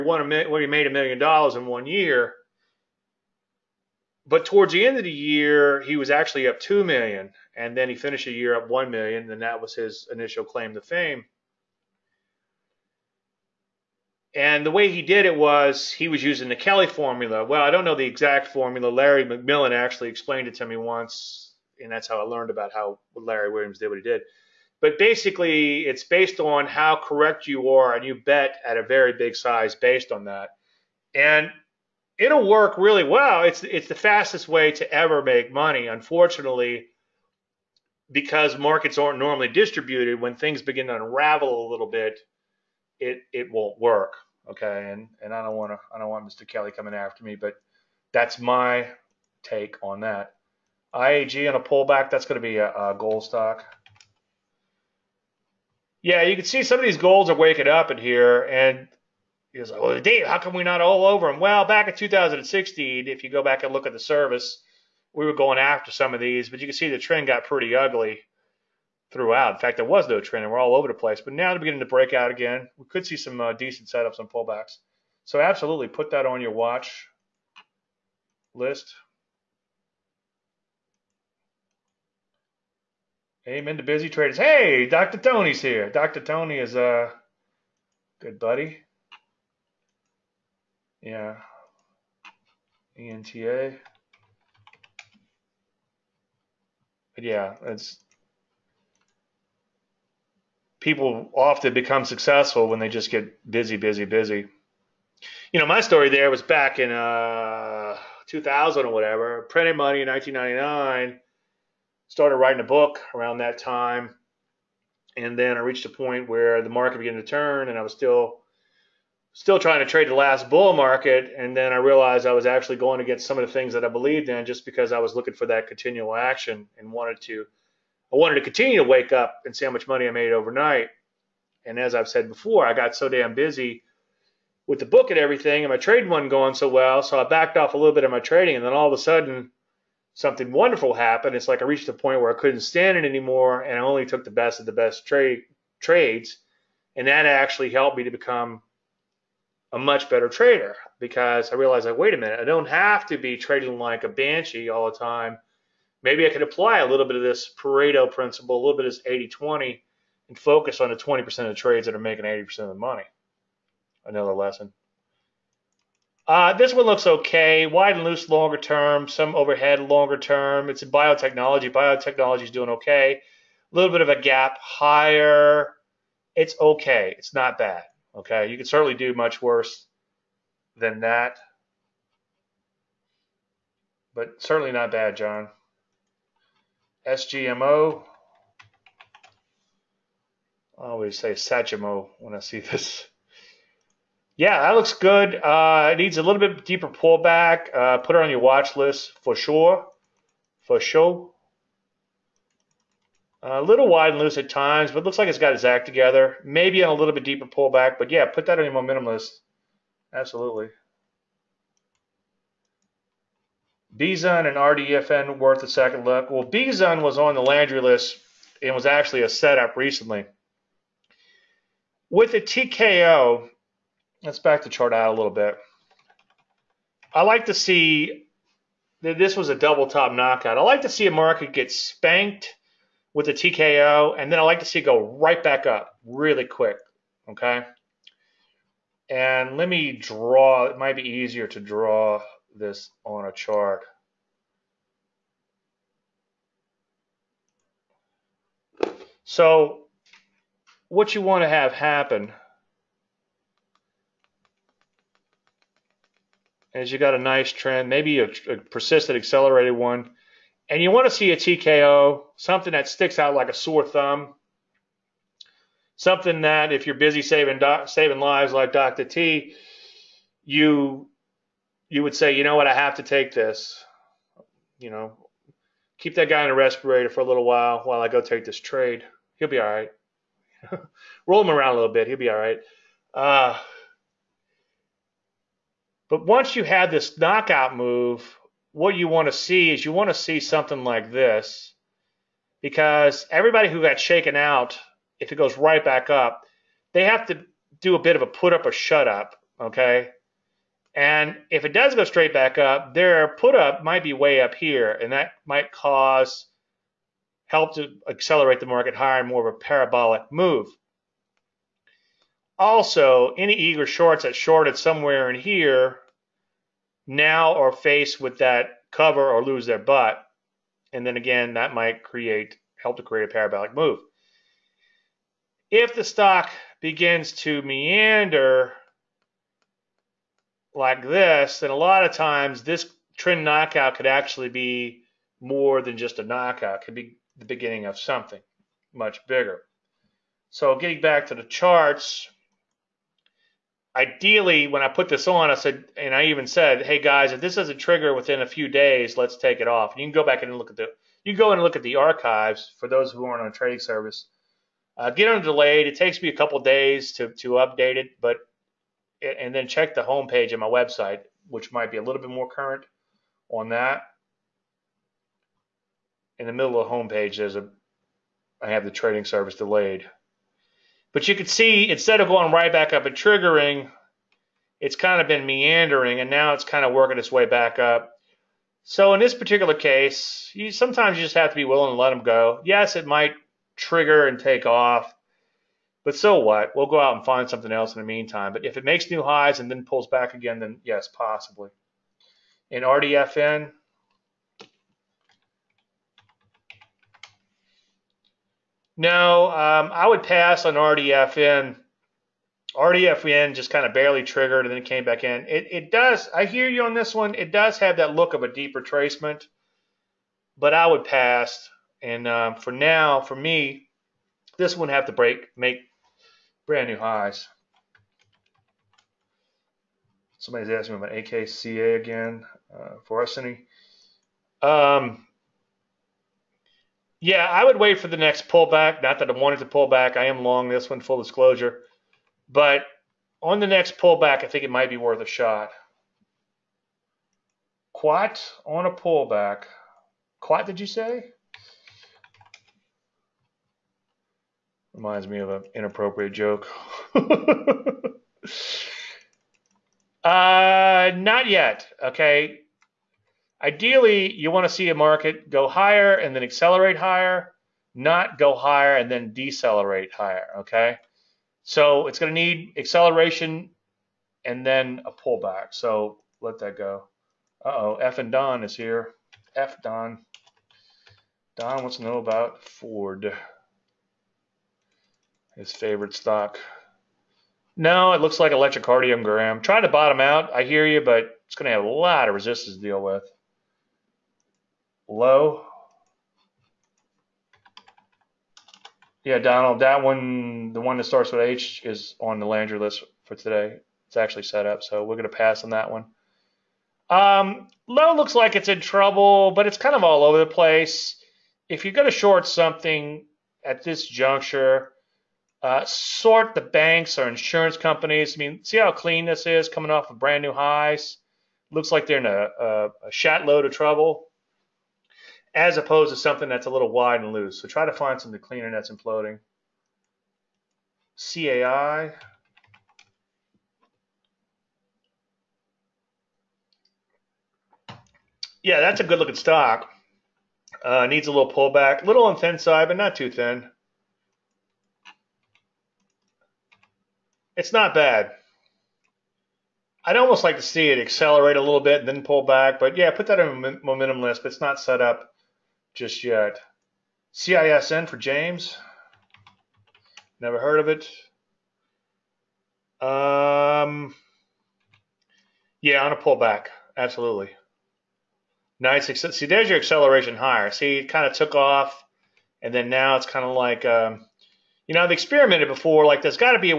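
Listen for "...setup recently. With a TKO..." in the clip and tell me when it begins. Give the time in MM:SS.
03:39.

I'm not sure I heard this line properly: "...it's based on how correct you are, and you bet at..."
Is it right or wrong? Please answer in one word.
right.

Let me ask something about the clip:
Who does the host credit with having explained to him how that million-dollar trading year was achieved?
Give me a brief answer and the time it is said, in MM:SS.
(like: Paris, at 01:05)
Larry McMillan, at 00:18.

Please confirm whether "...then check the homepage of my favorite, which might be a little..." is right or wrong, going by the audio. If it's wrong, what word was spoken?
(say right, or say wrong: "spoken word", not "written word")
wrong: "website", not "favorite".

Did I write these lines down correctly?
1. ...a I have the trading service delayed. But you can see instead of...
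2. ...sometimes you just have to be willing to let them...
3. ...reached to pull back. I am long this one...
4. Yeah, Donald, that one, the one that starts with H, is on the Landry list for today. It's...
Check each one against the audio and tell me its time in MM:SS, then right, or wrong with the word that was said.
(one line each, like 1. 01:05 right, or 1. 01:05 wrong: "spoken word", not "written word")
1. 06:07 right
2. 06:20 right
3. 07:09 wrong: "wanted", not "reached"
4. 08:09 right.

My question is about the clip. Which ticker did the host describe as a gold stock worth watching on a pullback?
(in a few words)
IAG.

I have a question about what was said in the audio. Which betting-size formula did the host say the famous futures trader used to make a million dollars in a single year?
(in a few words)
Kelly formula.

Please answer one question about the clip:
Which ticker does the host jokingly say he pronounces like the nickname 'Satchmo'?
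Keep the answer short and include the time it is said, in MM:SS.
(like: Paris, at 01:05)
SGMO, at 03:07.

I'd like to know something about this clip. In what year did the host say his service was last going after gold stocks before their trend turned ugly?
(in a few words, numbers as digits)
2016.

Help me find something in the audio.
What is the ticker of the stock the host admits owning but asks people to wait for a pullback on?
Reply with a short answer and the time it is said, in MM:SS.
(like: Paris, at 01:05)
AKCA, at 07:01.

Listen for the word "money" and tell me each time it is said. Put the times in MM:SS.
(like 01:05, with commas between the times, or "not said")
00:35, 01:49, 02:09, 02:42.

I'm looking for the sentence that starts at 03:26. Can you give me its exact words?
Maybe on a little bit deeper pullback, but yeah, put that on your momentum list.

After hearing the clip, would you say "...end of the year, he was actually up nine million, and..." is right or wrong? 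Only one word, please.
wrong.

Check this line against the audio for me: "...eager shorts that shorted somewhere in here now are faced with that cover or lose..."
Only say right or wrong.
right.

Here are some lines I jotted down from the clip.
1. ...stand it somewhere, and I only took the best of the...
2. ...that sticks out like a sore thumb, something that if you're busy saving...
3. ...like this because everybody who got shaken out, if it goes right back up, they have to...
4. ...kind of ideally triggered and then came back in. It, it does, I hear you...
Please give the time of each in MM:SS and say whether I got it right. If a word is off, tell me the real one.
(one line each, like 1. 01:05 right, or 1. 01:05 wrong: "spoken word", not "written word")
1. 02:22 wrong: "anymore", not "somewhere"
2. 04:22 right
3. 04:50 right
4. 06:43 wrong: "barely", not "ideally".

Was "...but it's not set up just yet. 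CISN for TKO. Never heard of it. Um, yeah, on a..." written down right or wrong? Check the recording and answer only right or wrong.
wrong.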